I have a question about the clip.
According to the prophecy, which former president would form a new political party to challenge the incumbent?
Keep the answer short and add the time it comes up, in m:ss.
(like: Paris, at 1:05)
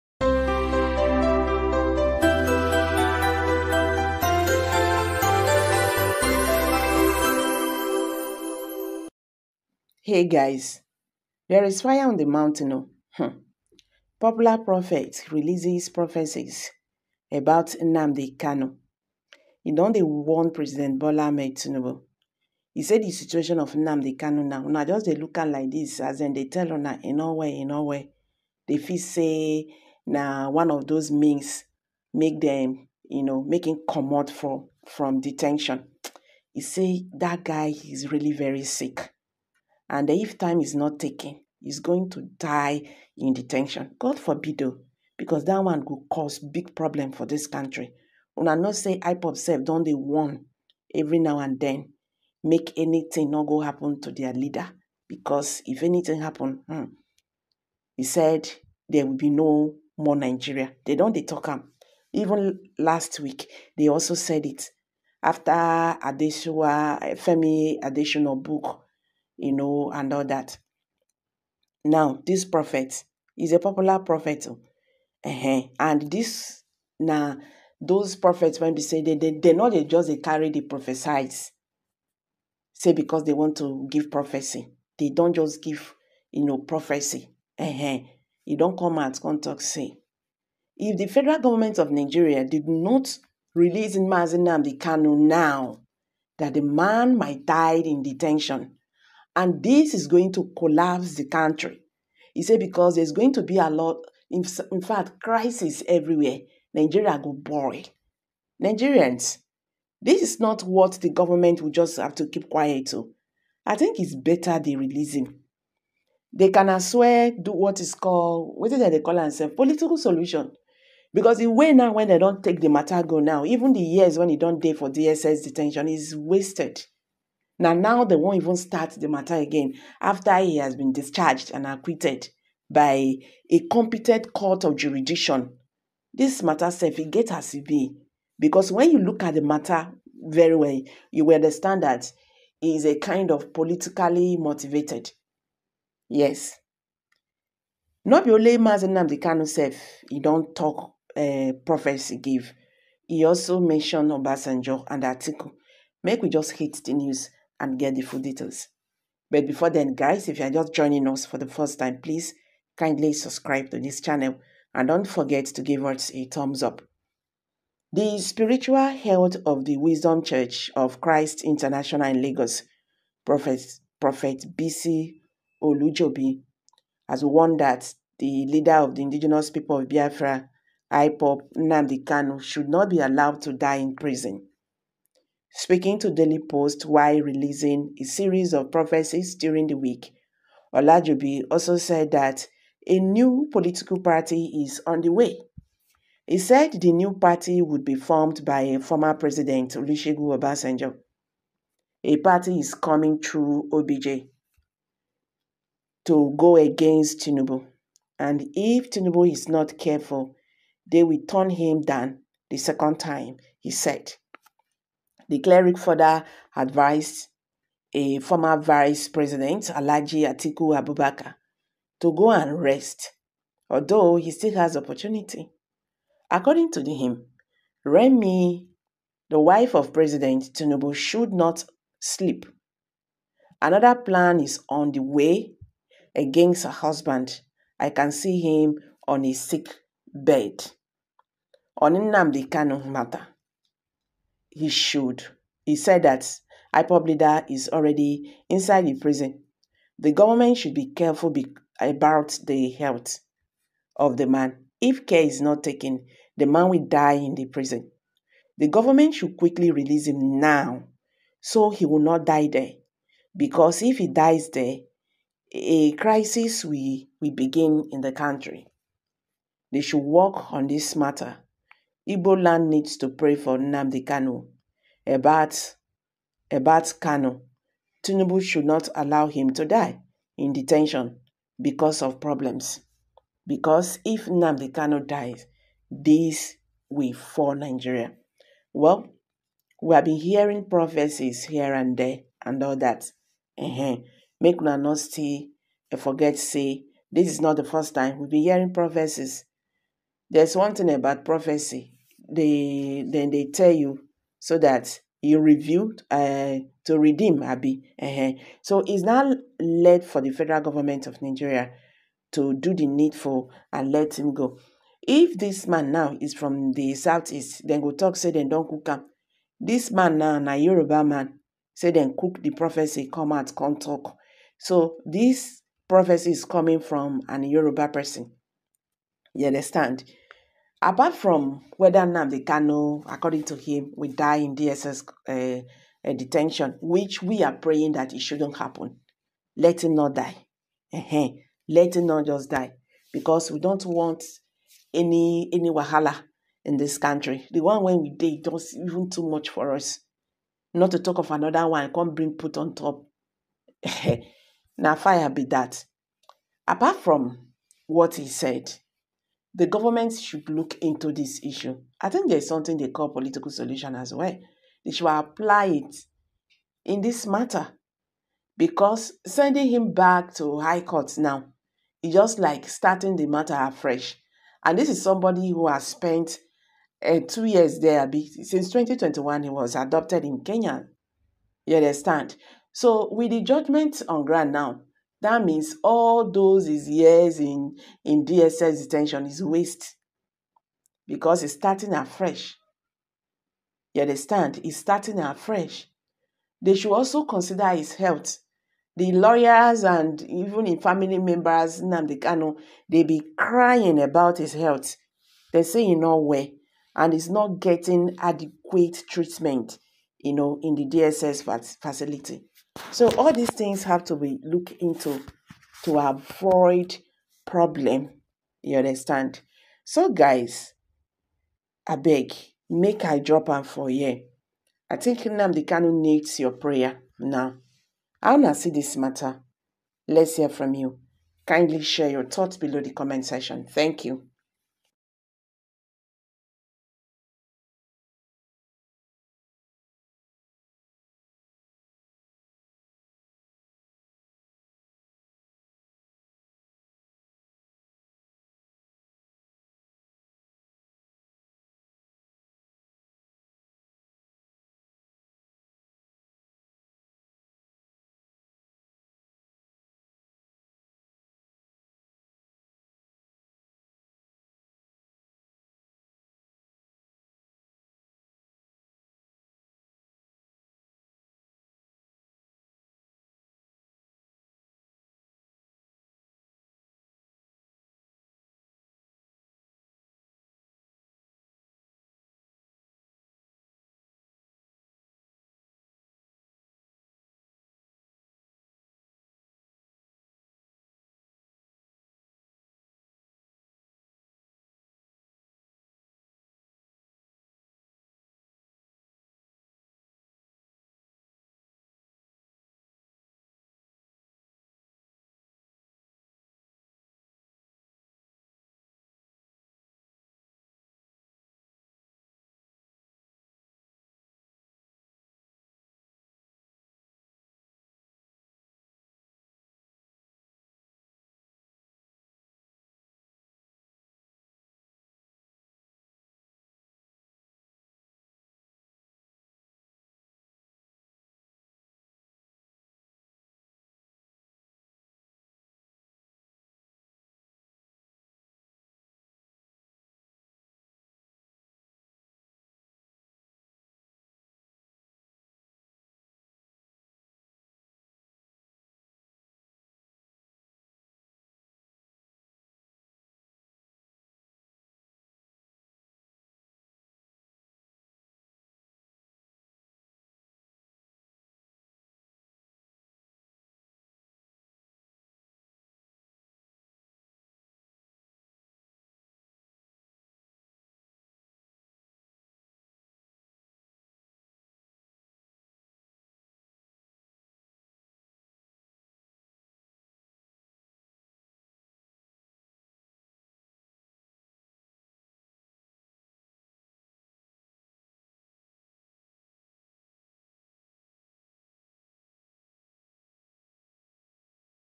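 Olusegun Obasanjo, at 3:19.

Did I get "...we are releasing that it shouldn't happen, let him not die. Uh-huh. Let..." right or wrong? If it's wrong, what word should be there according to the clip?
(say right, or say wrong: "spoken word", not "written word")
wrong: "praying", not "releasing".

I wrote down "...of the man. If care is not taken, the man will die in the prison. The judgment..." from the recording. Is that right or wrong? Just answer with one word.
wrong.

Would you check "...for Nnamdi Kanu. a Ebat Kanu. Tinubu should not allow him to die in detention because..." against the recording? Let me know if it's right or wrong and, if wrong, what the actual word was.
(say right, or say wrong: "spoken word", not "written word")
right.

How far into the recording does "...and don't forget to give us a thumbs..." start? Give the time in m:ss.
2:44.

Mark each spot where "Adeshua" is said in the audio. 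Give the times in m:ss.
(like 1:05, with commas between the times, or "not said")
1:05.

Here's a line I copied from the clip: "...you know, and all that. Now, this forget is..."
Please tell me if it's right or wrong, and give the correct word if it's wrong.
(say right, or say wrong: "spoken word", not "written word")
wrong: "prophet", not "forget".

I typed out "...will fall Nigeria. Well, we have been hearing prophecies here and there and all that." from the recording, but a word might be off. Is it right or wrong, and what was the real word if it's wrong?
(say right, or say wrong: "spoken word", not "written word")
right.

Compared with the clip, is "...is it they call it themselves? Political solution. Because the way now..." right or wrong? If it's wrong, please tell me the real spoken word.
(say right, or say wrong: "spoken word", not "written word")
right.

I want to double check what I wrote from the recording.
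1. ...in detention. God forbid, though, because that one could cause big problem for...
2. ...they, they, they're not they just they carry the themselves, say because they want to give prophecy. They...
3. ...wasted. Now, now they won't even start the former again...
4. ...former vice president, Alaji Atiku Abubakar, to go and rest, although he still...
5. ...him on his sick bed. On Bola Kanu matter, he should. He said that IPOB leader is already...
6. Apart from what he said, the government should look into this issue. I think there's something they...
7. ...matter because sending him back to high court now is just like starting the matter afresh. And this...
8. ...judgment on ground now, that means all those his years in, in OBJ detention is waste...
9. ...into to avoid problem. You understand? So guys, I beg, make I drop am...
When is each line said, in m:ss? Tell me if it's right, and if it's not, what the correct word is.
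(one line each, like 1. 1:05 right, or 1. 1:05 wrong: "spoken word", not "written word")
1. 0:43 right
2. 1:19 wrong: "prophesies", not "themselves"
3. 2:06 wrong: "matter", not "former"
4. 3:38 right
5. 3:58 wrong: "Nnamdi", not "Bola"
6. 5:56 right
7. 6:07 right
8. 6:23 wrong: "DSS", not "OBJ"
9. 6:54 right.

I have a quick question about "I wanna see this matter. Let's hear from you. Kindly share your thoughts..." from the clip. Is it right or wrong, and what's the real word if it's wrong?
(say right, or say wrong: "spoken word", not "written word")
right.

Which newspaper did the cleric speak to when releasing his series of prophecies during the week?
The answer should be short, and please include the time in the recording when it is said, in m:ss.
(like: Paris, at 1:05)
Daily Post, at 3:06.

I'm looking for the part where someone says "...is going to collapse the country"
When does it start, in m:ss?
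1:39.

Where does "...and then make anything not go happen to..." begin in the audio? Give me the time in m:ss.
0:51.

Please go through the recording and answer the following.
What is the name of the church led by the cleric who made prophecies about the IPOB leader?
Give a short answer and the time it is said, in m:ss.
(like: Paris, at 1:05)
Wisdom Church of Christ International, at 2:49.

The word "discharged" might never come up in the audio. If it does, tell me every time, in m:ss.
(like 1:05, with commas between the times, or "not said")
2:10.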